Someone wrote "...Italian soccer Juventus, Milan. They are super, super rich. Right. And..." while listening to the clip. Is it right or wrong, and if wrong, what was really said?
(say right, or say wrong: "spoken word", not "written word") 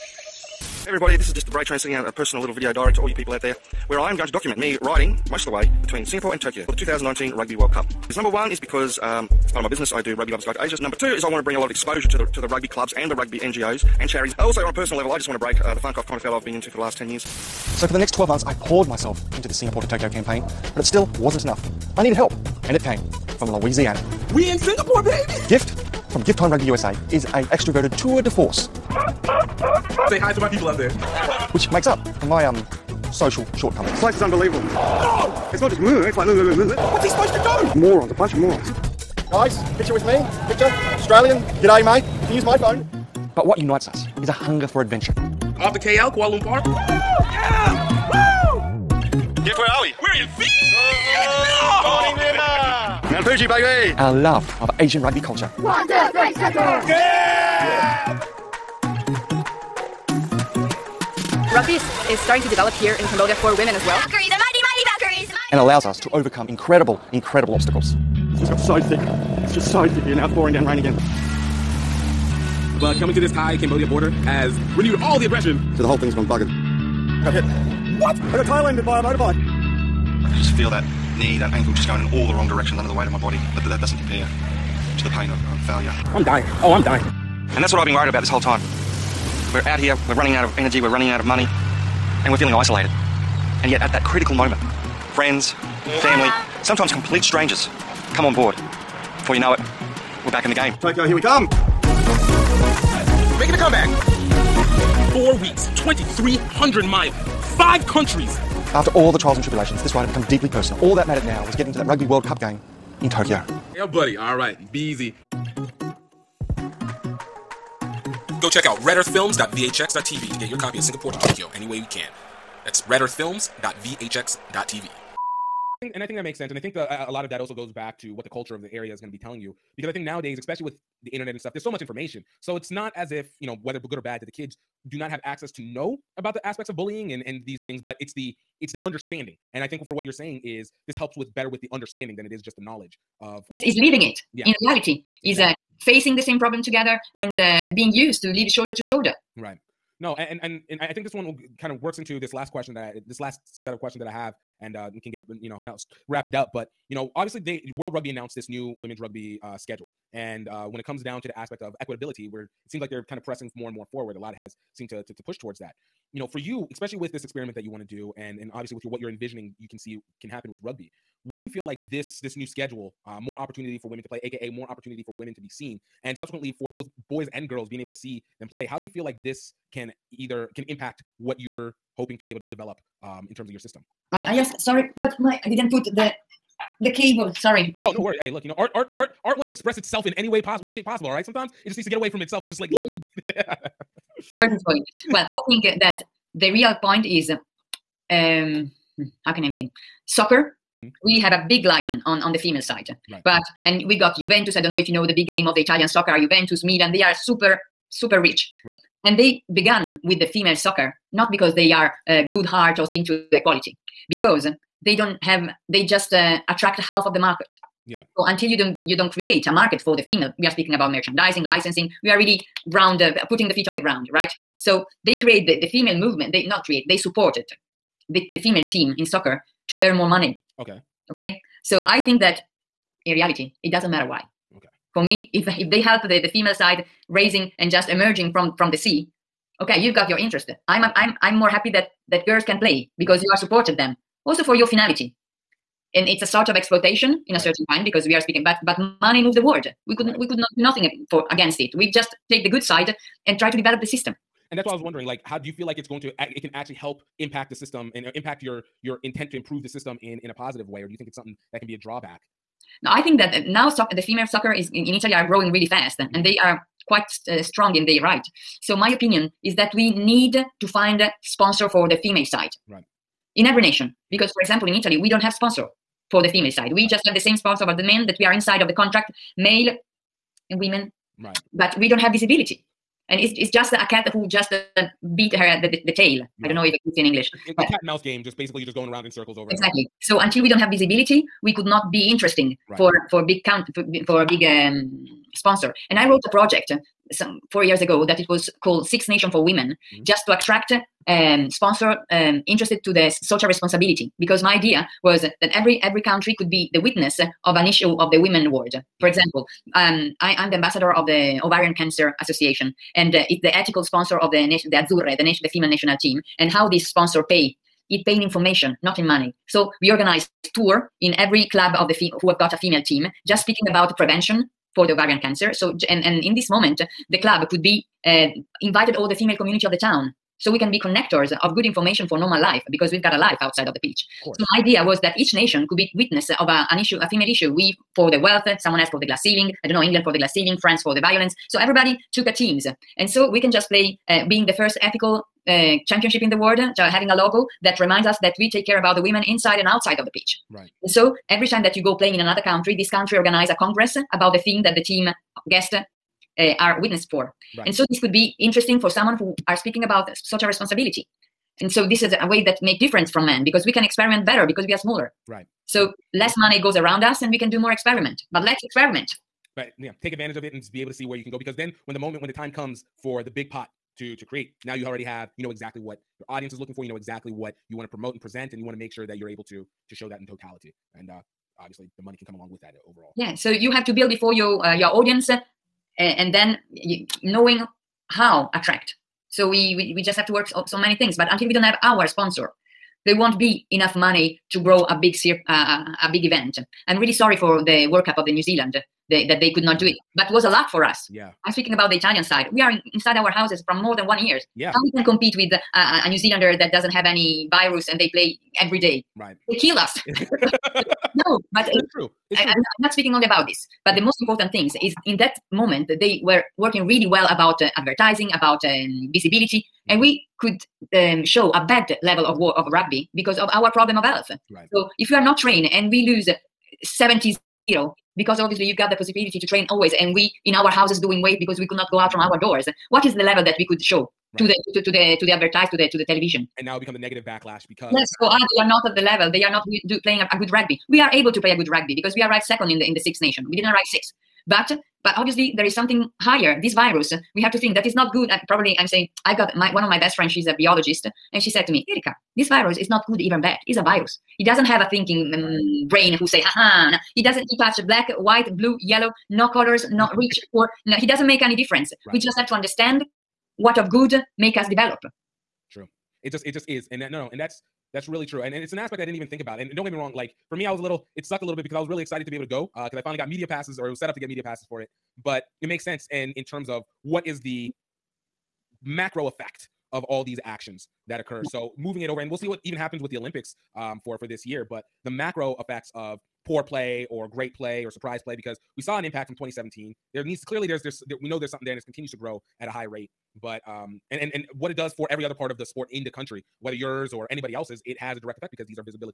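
right.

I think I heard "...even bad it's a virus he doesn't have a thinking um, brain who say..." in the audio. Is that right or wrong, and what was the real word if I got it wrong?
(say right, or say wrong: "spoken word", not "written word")
right.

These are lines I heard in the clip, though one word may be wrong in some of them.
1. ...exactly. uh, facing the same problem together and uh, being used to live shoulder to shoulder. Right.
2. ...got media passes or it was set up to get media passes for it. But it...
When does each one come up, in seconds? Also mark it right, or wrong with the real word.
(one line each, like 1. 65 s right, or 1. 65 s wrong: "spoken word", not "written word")
1. 145 s right
2. 473 s right.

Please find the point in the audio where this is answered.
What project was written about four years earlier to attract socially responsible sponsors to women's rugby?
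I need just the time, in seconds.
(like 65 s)
298 s.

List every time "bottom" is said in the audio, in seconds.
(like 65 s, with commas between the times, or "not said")
not said.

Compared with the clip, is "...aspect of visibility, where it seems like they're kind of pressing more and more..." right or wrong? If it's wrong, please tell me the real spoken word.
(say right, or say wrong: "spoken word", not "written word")
wrong: "equitability", not "visibility".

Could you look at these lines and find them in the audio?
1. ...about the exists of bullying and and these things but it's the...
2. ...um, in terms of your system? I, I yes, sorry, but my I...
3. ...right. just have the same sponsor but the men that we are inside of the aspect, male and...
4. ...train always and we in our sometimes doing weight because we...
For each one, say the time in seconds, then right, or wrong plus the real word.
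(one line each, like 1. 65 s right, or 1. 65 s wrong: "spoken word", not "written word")
1. 136 s wrong: "aspects", not "exists"
2. 183 s right
3. 276 s wrong: "contract", not "aspect"
4. 429 s wrong: "houses", not "sometimes".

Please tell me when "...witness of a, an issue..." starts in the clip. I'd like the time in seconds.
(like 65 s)
335 s.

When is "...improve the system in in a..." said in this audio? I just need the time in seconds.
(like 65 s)
259 s.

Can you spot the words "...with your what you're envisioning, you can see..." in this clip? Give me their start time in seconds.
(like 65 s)
168 s.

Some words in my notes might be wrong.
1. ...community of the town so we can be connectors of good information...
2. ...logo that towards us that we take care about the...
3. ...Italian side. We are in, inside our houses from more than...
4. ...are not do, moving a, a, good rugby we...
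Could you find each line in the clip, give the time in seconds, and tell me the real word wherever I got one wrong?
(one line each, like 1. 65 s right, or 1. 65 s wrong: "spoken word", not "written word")
1. 329 s right
2. 347 s wrong: "reminds", not "towards"
3. 401 s right
4. 439 s wrong: "playing", not "moving".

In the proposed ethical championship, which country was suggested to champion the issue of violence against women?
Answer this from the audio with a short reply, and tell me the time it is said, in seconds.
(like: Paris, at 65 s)
France, at 340 s.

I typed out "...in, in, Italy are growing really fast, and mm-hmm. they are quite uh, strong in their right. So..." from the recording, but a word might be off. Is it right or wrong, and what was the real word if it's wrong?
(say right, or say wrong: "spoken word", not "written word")
right.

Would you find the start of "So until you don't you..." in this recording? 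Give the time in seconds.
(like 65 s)
218 s.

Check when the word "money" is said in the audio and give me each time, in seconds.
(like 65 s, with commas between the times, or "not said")
91 s, 230 s, 249 s, 319 s, 366 s, 382 s, 393 s.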